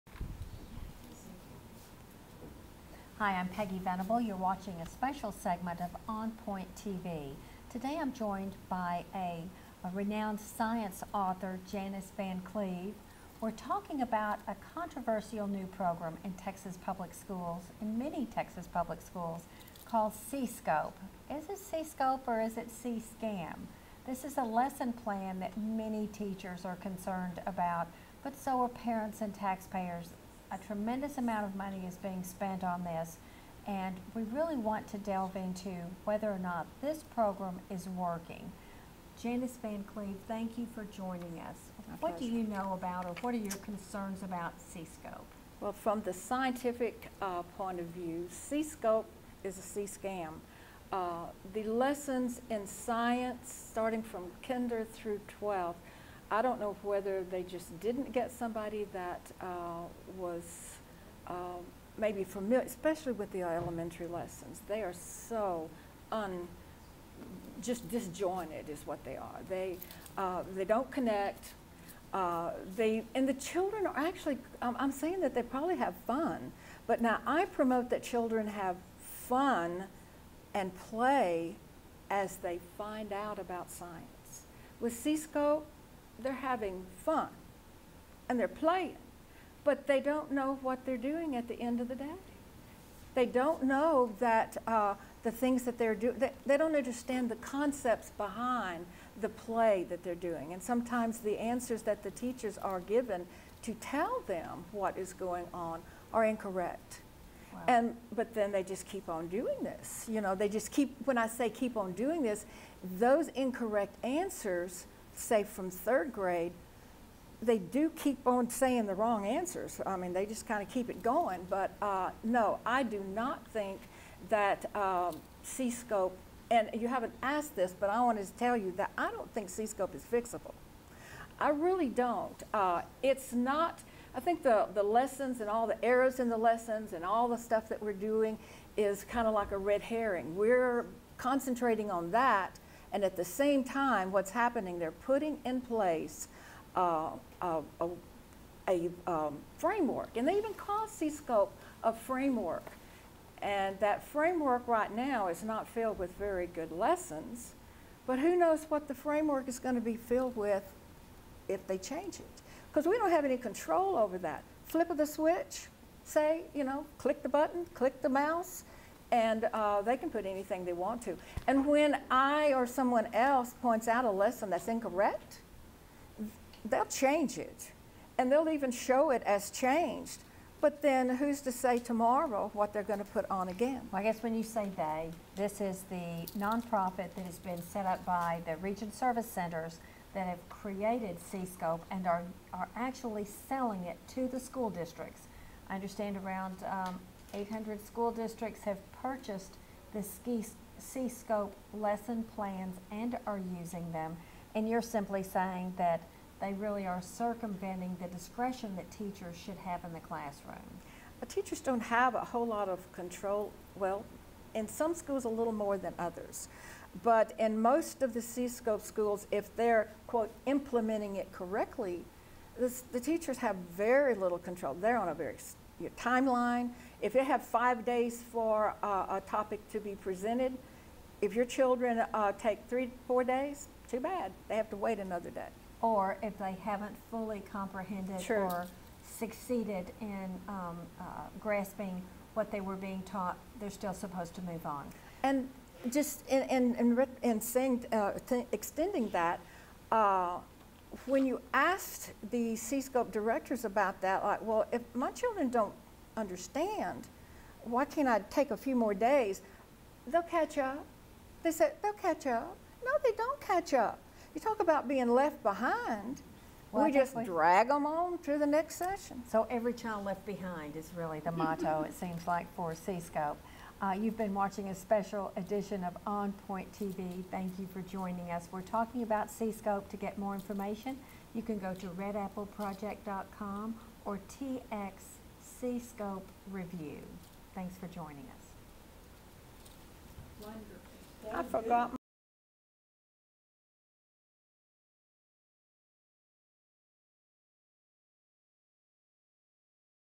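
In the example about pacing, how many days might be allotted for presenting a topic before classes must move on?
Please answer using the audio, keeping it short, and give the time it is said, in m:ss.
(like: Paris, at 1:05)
5, at 3:47.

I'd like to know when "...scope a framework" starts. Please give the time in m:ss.
2:30.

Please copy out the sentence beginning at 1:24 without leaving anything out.
With C-SCOPE, they're having fun and they're playing, but they don't know what they're doing at the end of the day.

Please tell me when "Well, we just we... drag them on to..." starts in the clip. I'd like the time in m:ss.
4:26.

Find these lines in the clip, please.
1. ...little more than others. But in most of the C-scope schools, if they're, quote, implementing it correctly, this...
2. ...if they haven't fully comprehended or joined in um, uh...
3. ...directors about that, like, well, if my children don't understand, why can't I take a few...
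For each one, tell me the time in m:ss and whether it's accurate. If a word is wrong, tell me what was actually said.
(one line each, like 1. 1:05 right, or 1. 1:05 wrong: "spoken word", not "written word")
1. 3:35 right
2. 3:56 wrong: "succeeded", not "joined"
3. 4:13 right.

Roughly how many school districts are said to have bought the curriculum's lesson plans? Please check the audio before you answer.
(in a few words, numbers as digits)
800.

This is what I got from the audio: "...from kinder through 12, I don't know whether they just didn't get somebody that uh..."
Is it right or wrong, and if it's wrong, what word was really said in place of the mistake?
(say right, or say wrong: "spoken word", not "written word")
right.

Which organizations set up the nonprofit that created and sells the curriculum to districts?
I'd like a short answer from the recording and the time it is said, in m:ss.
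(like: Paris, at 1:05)
Region Service Centers, at 3:08.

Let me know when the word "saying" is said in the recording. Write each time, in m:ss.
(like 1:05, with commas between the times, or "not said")
1:14, 1:58, 3:25, 4:07.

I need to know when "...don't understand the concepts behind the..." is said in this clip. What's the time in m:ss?
1:36.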